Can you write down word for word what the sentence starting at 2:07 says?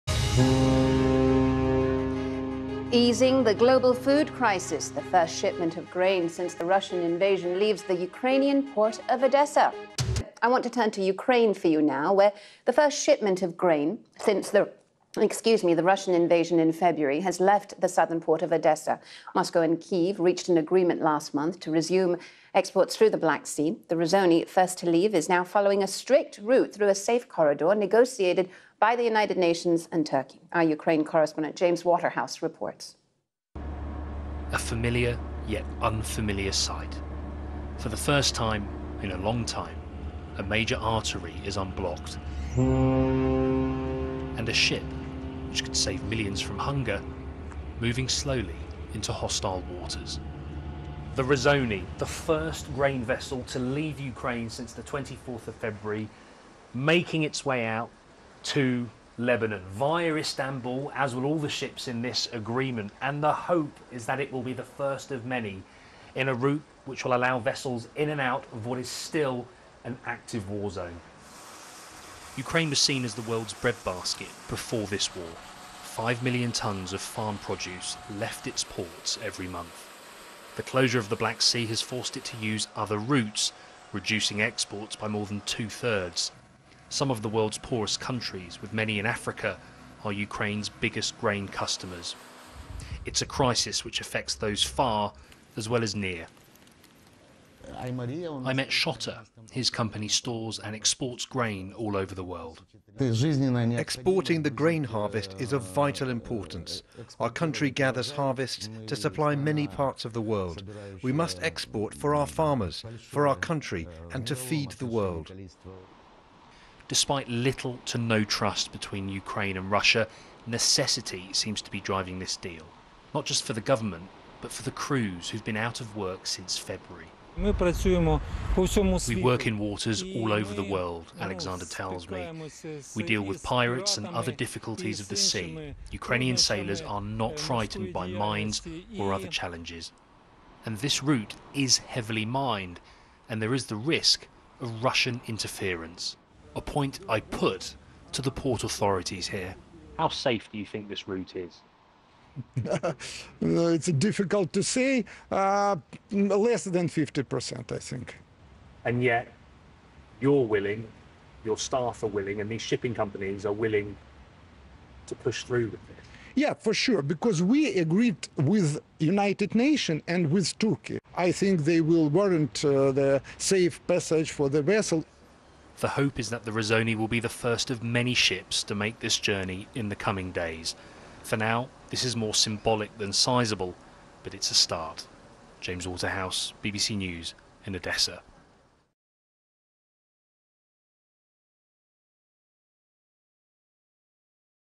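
We work in waters all over the world, Alexander tells me.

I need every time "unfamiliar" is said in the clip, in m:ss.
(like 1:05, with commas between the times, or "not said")
0:35.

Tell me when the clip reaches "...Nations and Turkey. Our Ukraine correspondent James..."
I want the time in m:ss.
0:29.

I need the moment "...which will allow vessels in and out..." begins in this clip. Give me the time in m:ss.
1:06.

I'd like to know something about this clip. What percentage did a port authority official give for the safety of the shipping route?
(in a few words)
less than 50%.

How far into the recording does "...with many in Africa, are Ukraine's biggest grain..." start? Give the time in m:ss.
1:28.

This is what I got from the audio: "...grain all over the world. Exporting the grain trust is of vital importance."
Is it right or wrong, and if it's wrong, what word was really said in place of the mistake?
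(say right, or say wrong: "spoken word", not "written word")
wrong: "harvest", not "trust".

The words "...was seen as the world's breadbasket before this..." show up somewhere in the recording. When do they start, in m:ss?
1:12.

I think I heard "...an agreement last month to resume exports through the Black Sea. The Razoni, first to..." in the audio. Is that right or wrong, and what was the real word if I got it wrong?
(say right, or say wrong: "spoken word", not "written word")
right.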